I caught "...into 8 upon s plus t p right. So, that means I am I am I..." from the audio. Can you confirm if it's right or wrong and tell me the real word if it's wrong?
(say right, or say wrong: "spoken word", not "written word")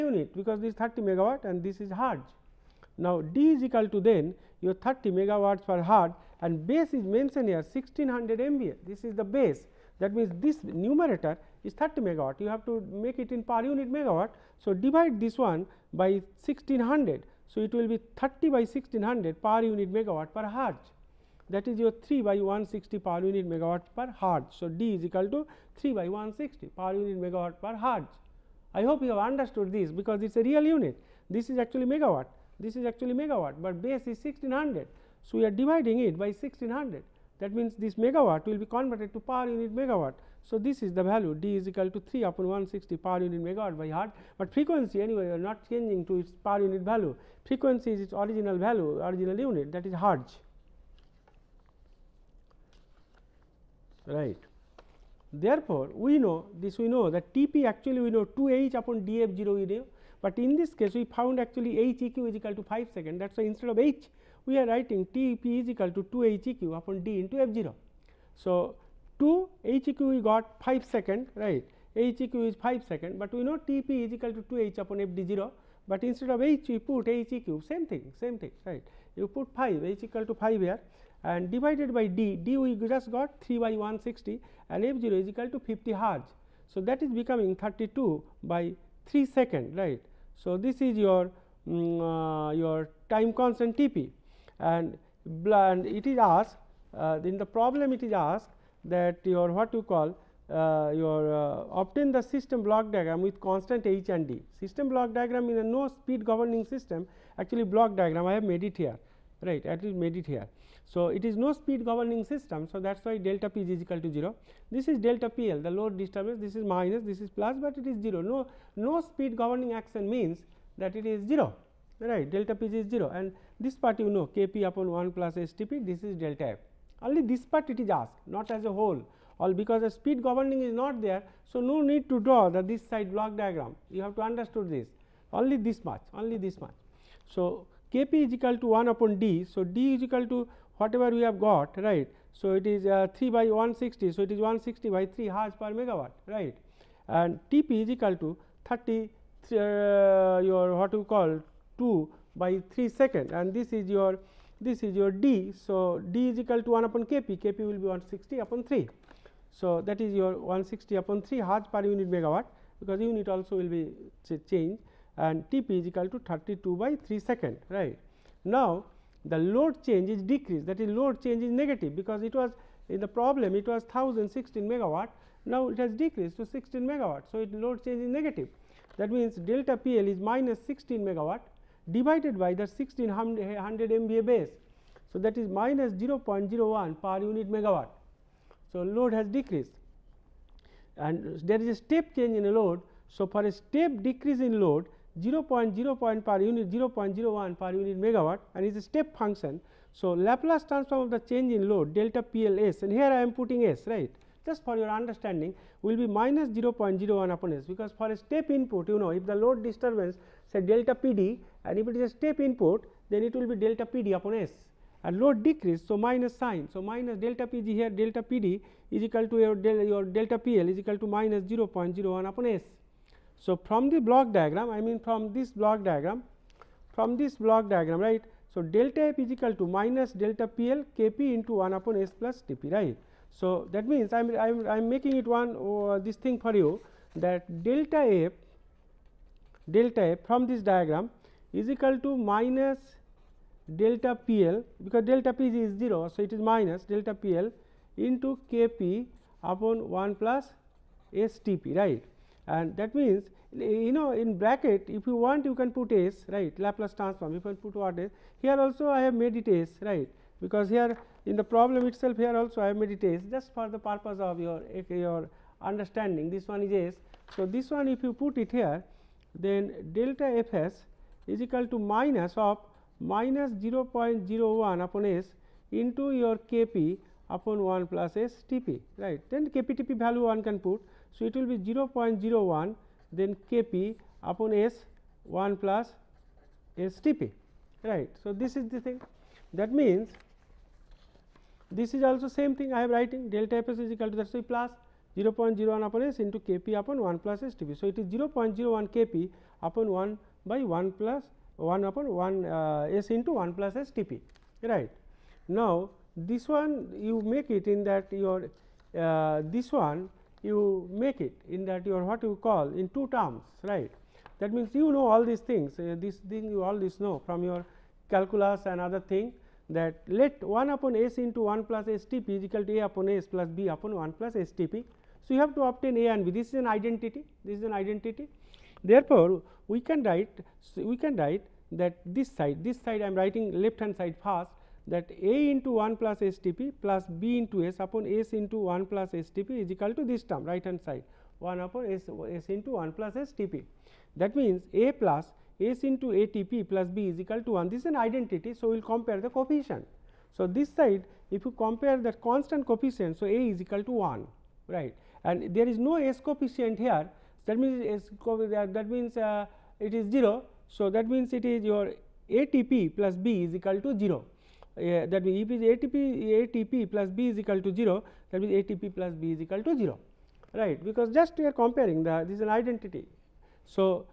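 wrong: "1", not "8".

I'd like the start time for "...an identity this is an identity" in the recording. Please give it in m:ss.
5:26.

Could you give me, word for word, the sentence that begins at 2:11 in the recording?
So, no need to draw the this side block diagram you have to understood this only this much only this much.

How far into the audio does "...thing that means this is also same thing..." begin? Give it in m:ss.
4:48.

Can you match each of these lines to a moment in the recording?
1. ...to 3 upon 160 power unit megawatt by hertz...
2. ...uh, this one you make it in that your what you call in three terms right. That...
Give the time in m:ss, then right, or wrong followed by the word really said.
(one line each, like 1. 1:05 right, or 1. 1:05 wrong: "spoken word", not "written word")
1. 0:41 right
2. 5:08 wrong: "two", not "three".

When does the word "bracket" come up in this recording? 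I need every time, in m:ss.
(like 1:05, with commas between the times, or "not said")
4:14.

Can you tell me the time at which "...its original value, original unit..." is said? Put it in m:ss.
0:47.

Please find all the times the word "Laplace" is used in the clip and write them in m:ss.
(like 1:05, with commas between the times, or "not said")
3:20, 4:16.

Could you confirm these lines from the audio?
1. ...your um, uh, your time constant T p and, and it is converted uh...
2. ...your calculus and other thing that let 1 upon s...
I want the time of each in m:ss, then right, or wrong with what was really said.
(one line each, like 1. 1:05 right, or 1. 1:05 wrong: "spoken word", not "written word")
1. 1:30 wrong: "asked", not "converted"
2. 5:17 right.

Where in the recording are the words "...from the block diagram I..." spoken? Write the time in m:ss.
3:43.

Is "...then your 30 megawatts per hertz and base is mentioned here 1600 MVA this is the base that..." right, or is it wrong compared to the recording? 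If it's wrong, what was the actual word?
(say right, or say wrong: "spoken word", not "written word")
right.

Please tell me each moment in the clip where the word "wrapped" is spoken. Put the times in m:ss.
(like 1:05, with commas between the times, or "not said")
not said.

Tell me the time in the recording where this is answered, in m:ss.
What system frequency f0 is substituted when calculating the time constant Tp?
1:25.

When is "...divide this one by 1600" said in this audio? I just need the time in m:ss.
0:14.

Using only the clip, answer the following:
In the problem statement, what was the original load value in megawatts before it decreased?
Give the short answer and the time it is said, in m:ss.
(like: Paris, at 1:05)
1016 megawatts, at 2:53.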